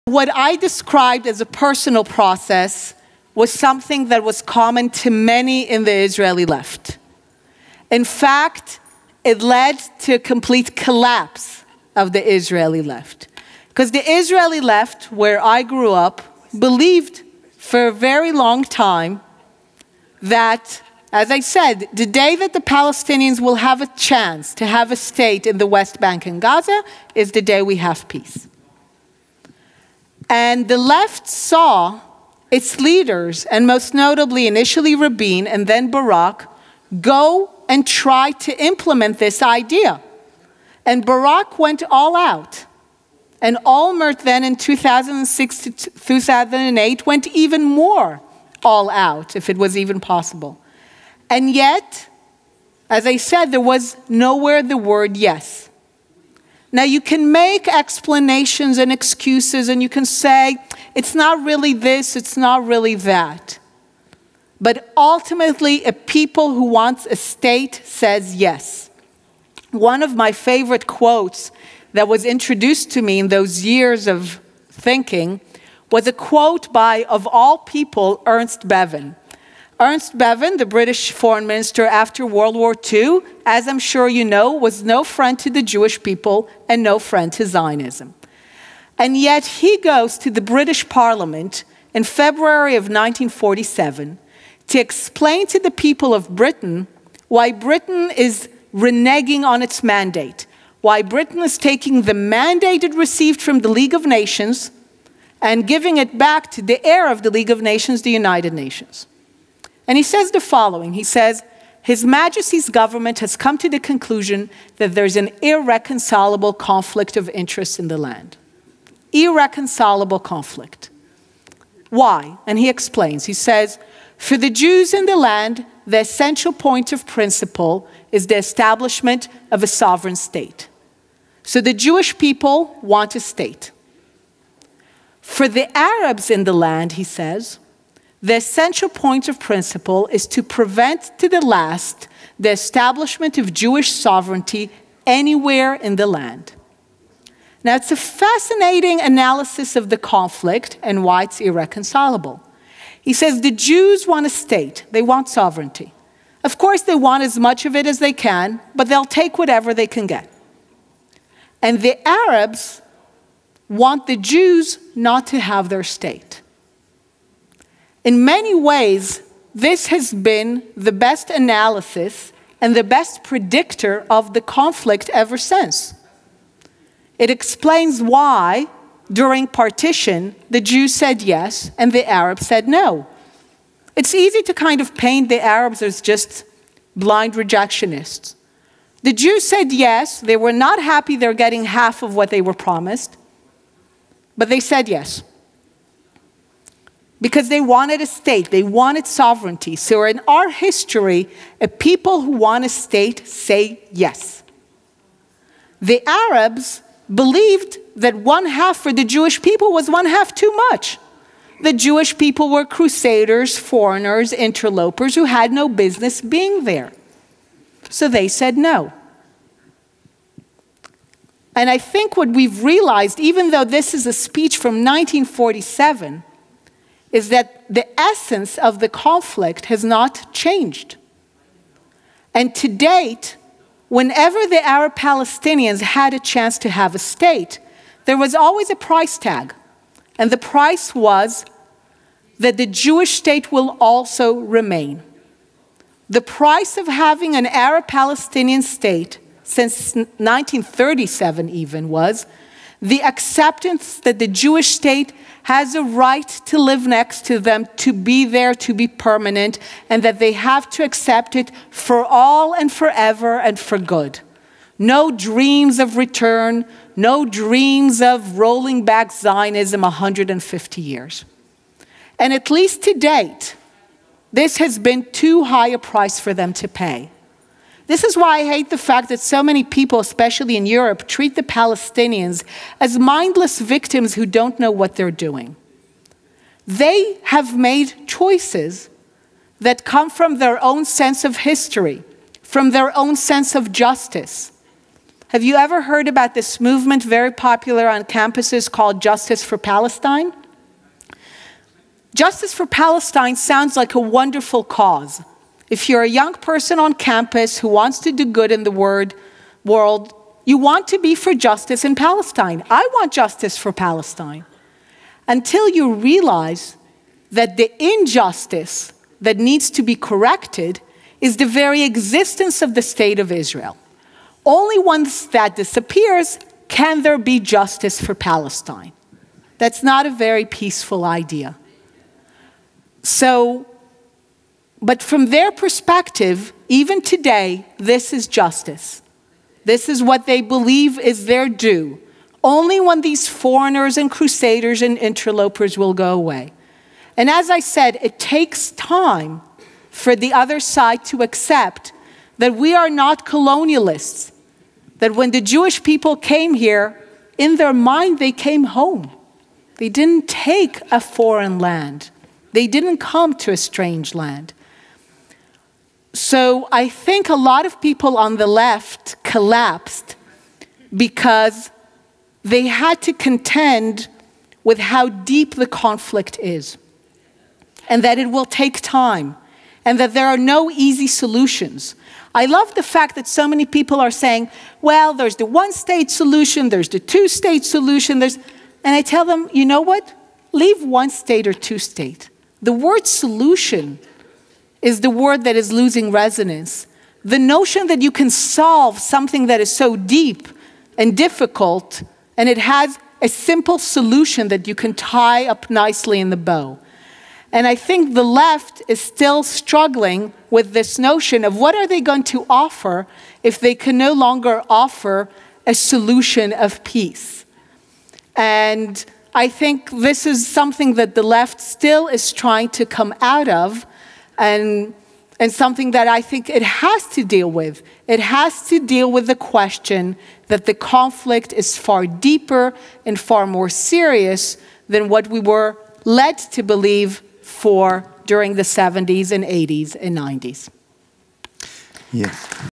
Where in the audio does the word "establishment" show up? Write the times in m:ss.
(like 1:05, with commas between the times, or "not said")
2:08, 2:22.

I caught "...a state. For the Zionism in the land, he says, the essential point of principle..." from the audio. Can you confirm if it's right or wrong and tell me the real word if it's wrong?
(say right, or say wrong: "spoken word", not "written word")
wrong: "Arabs", not "Zionism".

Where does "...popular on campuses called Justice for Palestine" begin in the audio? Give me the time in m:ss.
4:57.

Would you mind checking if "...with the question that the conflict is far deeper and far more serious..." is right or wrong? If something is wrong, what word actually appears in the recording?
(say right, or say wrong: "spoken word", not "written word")
right.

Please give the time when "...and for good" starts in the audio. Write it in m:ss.
4:23.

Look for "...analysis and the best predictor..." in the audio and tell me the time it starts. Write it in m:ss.
2:51.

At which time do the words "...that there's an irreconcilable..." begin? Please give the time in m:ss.
1:54.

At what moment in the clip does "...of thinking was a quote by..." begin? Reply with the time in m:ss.
1:14.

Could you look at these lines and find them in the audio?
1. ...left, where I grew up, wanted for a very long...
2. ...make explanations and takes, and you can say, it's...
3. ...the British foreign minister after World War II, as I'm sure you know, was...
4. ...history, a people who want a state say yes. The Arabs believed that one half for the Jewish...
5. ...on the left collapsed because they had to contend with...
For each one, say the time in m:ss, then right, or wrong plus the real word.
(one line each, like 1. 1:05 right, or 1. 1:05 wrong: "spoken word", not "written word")
1. 0:14 wrong: "believed", not "wanted"
2. 0:57 wrong: "excuses", not "takes"
3. 1:20 right
4. 3:20 right
5. 6:08 right.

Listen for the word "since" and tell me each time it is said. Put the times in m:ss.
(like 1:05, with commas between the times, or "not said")
2:55, 4:09.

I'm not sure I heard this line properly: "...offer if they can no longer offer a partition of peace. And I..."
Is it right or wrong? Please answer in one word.
wrong.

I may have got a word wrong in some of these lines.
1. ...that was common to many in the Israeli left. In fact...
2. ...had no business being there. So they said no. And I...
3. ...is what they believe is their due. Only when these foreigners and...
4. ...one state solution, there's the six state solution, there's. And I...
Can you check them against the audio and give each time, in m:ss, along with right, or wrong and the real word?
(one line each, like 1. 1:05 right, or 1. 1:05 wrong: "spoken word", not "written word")
1. 0:04 right
2. 3:35 right
3. 5:39 right
4. 6:25 wrong: "two", not "six".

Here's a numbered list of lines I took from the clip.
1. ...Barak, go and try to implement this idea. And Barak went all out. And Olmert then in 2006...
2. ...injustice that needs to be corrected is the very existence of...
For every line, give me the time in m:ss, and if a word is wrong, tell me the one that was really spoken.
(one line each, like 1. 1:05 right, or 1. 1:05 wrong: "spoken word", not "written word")
1. 0:35 right
2. 5:17 right.